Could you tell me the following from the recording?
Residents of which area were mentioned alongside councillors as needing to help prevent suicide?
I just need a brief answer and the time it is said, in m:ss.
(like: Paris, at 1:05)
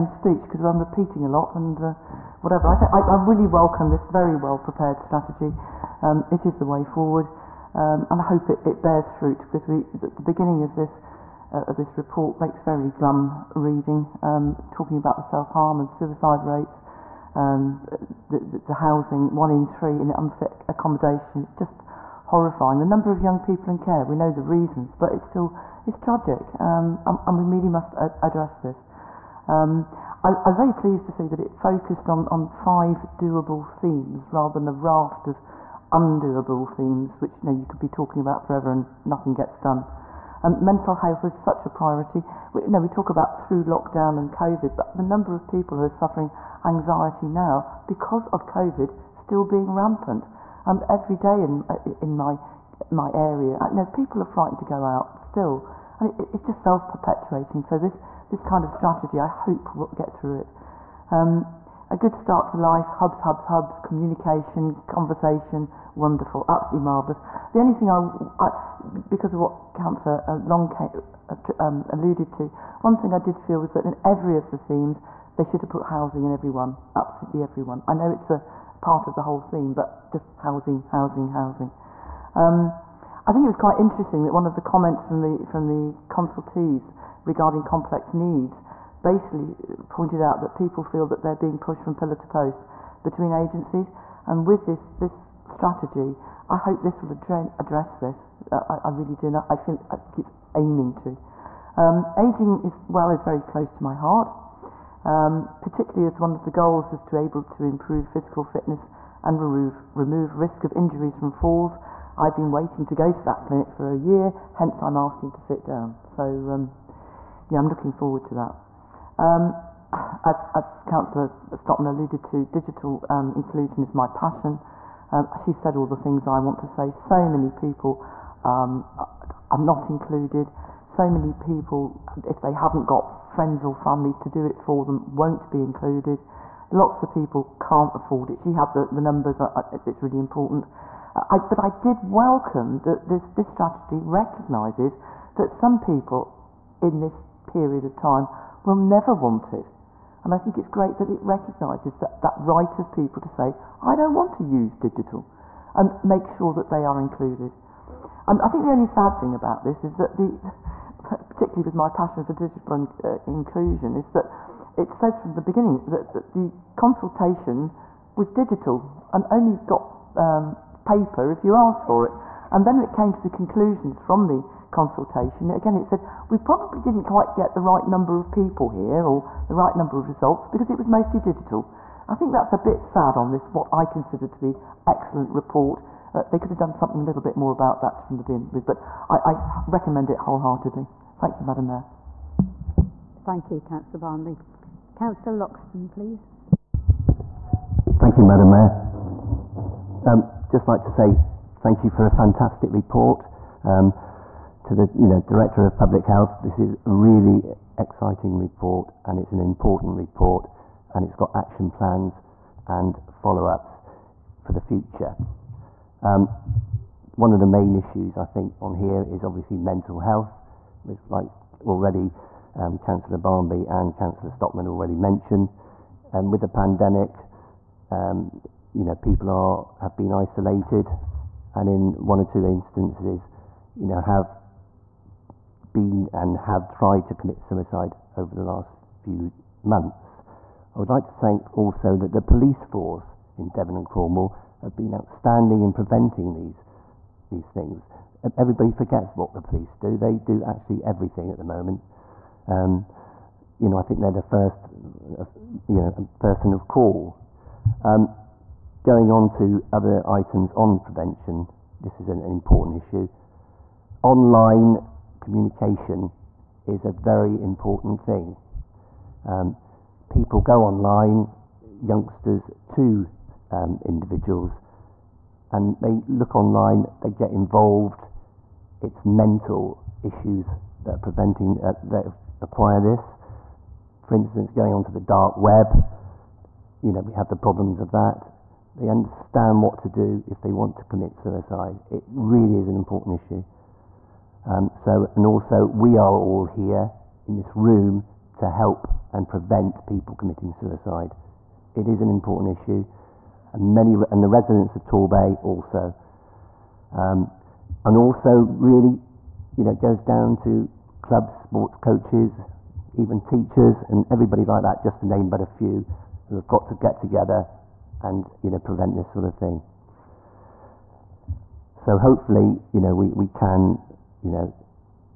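Torbay, at 5:04.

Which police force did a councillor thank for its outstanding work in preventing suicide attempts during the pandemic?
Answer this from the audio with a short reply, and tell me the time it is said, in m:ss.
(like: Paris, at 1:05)
Devon and Cornwall, at 4:03.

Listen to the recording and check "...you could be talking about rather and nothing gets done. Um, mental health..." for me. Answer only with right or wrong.
wrong.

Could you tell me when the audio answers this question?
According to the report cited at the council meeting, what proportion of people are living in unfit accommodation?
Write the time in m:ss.
0:19.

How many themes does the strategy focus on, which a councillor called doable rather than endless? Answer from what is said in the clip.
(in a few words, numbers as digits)
5.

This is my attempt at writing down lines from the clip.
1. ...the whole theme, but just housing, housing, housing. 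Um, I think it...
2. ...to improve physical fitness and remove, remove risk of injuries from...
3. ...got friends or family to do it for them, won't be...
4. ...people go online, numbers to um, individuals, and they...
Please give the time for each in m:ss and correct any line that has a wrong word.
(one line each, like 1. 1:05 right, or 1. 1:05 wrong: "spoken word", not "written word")
1. 1:19 right
2. 1:47 right
3. 2:12 right
4. 4:30 wrong: "youngsters", not "numbers".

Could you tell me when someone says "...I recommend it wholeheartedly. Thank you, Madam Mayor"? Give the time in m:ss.
3:09.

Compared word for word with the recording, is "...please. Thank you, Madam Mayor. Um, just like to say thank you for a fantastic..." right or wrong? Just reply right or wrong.
right.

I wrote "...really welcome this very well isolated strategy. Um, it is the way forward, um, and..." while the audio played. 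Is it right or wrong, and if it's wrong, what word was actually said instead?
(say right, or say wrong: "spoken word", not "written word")
wrong: "prepared", not "isolated".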